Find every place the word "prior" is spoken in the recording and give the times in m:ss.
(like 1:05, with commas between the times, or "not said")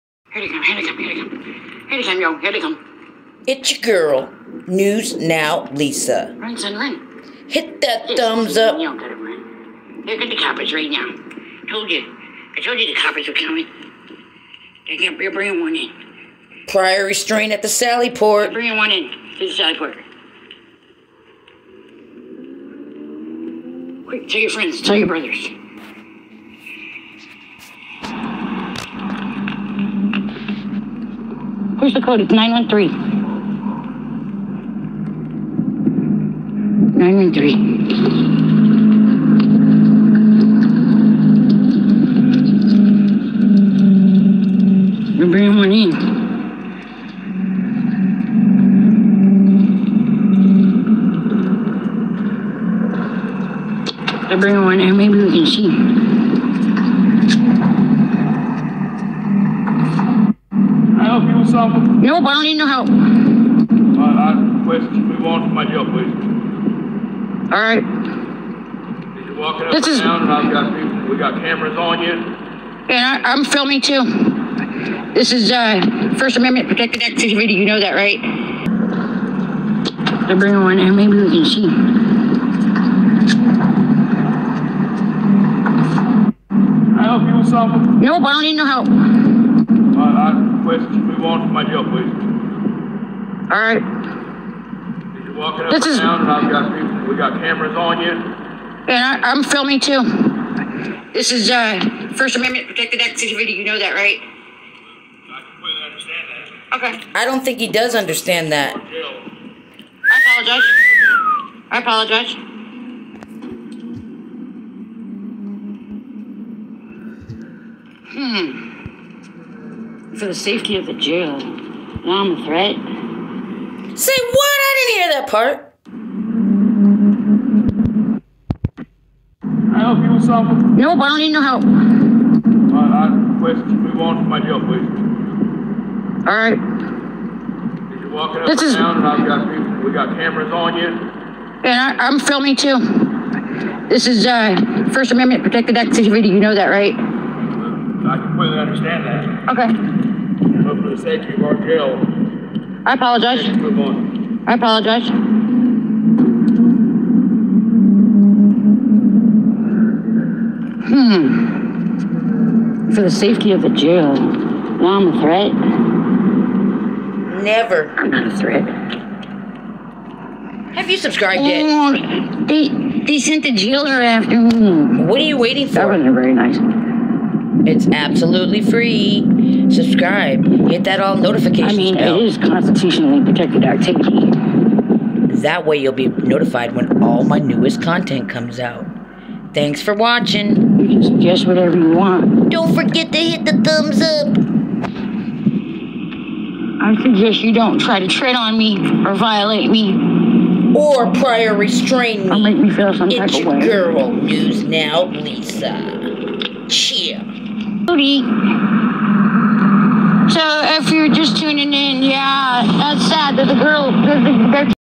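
0:16, 3:21.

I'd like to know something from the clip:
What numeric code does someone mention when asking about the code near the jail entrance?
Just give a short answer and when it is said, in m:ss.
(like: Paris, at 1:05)
913, at 0:32.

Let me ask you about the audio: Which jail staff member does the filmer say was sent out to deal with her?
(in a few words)
the jailer.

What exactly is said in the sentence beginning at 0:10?
Look at the coppers right now.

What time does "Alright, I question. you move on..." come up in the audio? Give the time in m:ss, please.
2:11.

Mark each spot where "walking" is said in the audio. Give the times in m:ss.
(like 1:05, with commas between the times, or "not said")
1:09, 1:35, 2:18.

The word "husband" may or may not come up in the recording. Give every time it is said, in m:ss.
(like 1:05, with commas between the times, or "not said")
not said.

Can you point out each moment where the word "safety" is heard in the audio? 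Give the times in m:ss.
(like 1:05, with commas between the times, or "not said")
2:00, 2:43.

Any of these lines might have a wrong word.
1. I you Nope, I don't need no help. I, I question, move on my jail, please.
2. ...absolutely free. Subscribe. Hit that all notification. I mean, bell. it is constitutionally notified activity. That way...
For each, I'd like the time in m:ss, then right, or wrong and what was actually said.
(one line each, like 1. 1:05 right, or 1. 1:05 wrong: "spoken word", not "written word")
1. 1:26 right
2. 2:57 wrong: "protected", not "notified".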